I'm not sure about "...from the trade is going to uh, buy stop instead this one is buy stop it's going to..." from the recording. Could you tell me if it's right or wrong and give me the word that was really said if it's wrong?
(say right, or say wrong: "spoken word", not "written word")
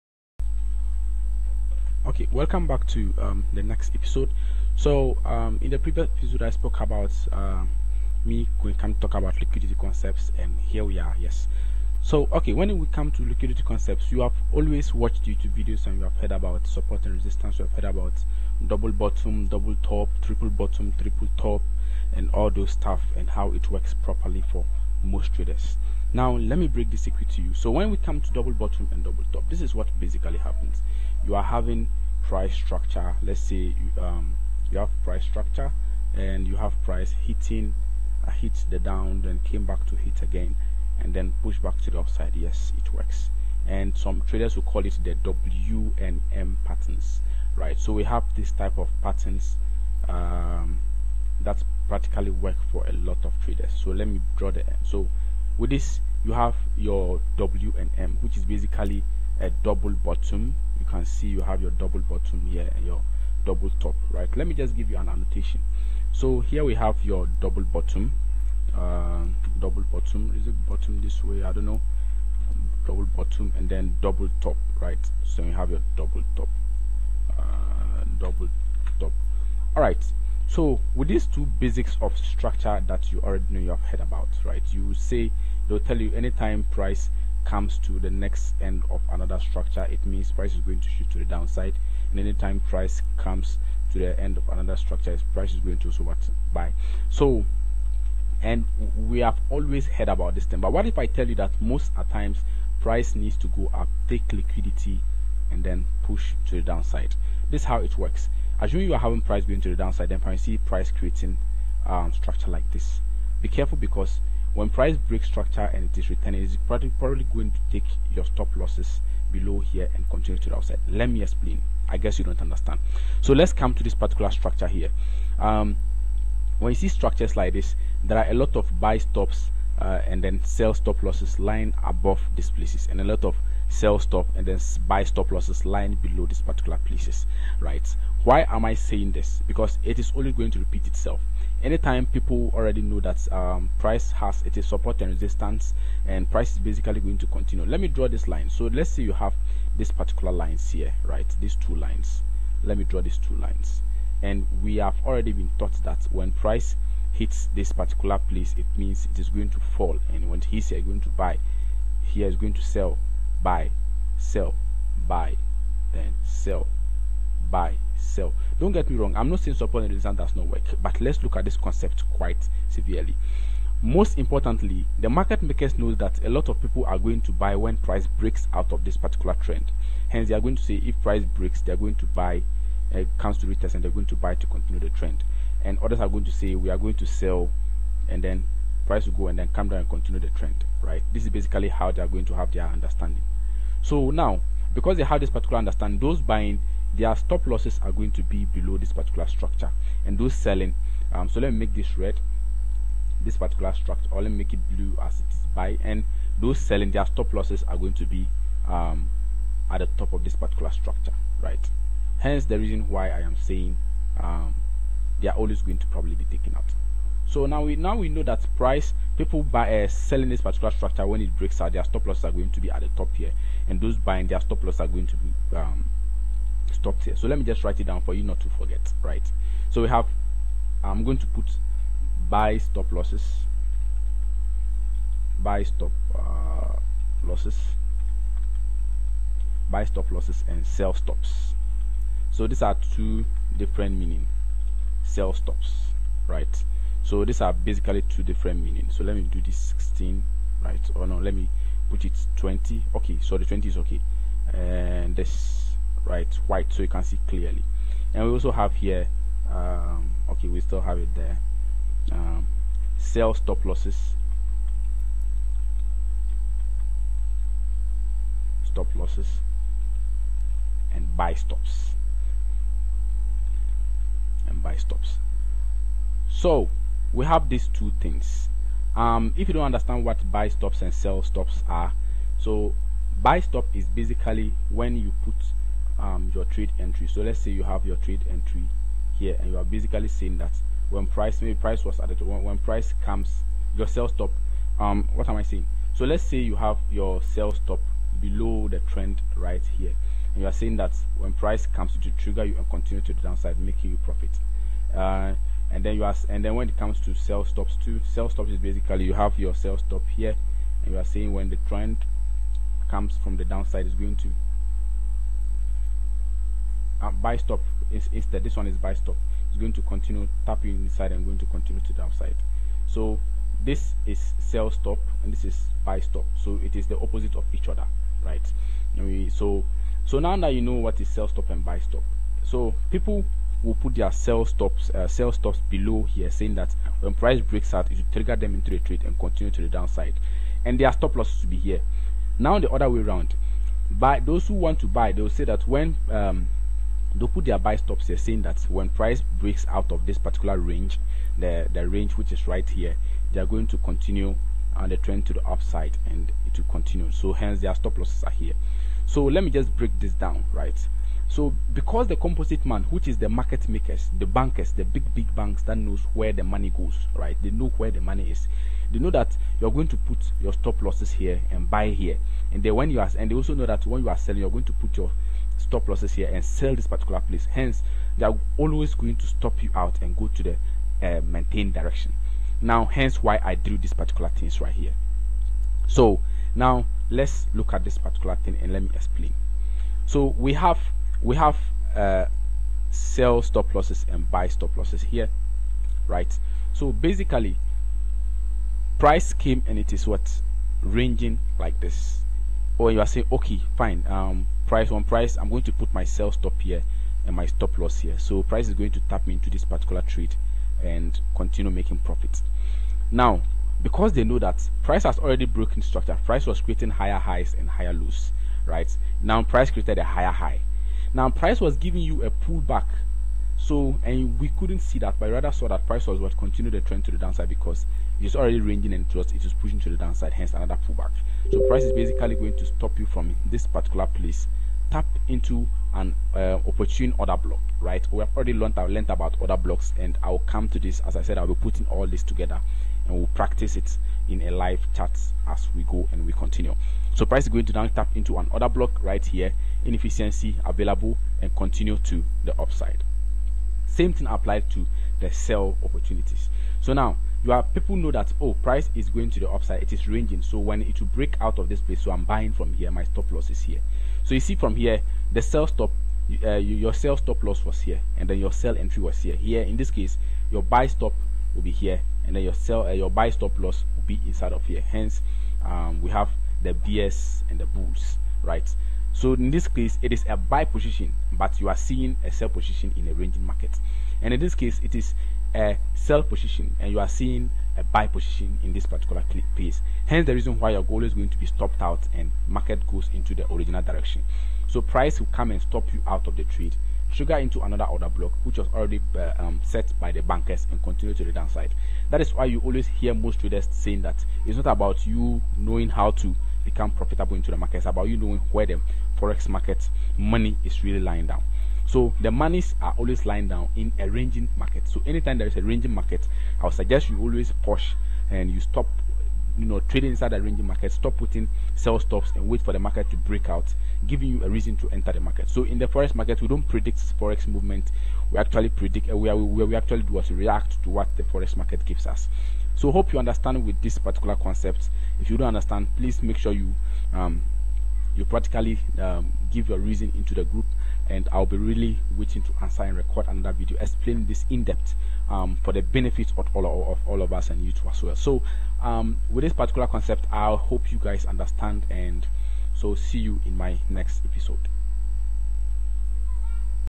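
wrong: "downside", not "trade".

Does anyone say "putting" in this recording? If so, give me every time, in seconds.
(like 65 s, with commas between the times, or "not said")
441 s, 521 s.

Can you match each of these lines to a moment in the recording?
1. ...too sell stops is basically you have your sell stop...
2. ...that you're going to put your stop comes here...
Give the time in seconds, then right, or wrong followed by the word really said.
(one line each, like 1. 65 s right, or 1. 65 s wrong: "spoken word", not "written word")
1. 307 s right
2. 369 s wrong: "losses", not "comes".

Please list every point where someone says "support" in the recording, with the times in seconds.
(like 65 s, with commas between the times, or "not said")
16 s, 144 s, 169 s.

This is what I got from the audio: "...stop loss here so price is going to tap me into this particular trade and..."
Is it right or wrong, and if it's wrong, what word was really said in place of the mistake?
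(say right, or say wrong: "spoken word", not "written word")
right.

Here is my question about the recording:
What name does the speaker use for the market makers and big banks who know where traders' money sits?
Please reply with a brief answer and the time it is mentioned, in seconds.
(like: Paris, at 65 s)
composite man, at 362 s.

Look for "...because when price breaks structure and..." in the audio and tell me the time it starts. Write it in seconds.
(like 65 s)
113 s.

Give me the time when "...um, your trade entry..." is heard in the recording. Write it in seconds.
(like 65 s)
286 s.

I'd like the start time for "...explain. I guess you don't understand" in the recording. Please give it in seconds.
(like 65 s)
121 s.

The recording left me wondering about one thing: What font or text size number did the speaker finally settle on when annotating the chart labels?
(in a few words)
20.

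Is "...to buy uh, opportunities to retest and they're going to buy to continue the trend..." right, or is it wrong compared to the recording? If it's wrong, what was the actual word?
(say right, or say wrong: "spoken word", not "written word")
wrong: "comes", not "opportunities".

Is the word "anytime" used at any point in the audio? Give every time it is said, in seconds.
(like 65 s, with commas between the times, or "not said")
86 s, 92 s, 141 s, 515 s.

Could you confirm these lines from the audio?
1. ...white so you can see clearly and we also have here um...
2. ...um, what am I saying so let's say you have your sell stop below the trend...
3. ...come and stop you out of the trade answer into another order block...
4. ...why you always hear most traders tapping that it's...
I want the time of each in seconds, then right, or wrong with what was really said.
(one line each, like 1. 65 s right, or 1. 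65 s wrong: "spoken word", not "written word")
1. 256 s right
2. 294 s right
3. 495 s wrong: "trigger", not "answer"
4. 502 s wrong: "saying", not "tapping".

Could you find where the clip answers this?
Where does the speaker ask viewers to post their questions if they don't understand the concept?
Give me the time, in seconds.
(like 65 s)
540 s.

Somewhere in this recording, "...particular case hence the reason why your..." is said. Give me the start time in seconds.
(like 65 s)
488 s.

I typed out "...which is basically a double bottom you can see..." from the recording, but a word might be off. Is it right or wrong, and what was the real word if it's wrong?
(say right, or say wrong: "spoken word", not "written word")
right.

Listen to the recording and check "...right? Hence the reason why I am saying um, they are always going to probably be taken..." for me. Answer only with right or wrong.
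right.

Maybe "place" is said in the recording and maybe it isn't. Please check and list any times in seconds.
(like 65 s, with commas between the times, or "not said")
132 s, 136 s, 158 s, 377 s, 434 s, 461 s.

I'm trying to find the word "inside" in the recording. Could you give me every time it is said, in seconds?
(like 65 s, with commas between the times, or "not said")
320 s, 474 s, 520 s.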